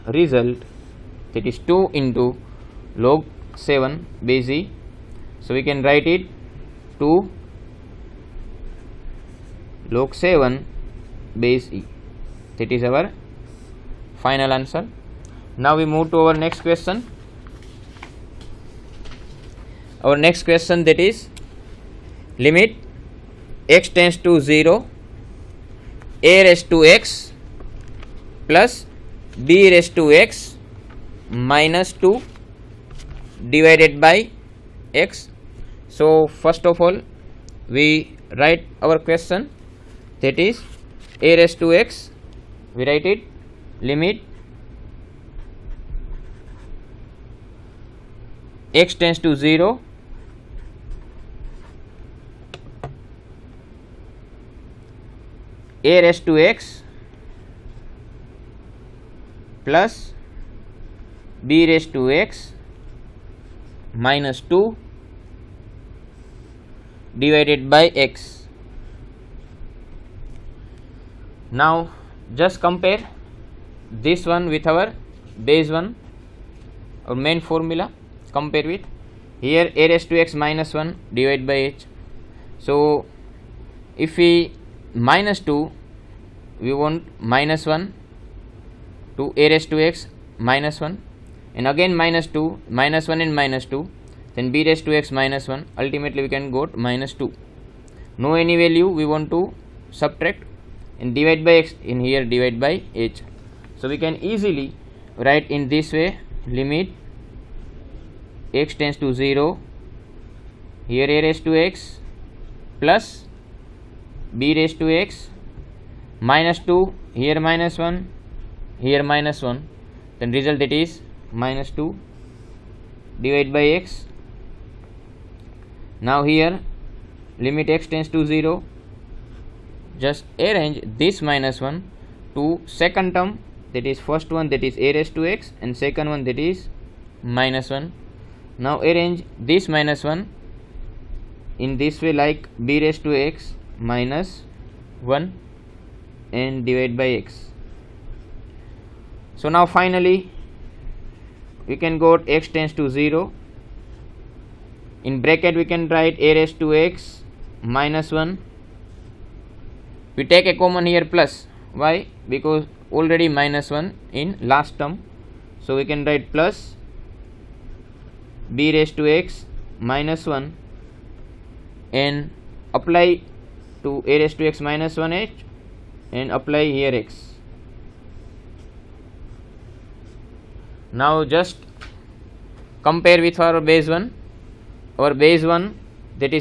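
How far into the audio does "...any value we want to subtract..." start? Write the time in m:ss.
1:38.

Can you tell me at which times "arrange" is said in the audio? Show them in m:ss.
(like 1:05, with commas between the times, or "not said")
2:10, 2:18.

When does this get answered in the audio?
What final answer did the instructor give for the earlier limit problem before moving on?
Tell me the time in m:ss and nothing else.
0:07.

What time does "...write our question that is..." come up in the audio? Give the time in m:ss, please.
0:38.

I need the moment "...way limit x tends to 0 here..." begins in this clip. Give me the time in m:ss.
1:45.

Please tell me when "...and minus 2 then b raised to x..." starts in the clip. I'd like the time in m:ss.
1:33.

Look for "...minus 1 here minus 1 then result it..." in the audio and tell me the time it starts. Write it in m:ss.
1:57.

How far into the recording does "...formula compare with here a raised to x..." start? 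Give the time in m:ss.
1:17.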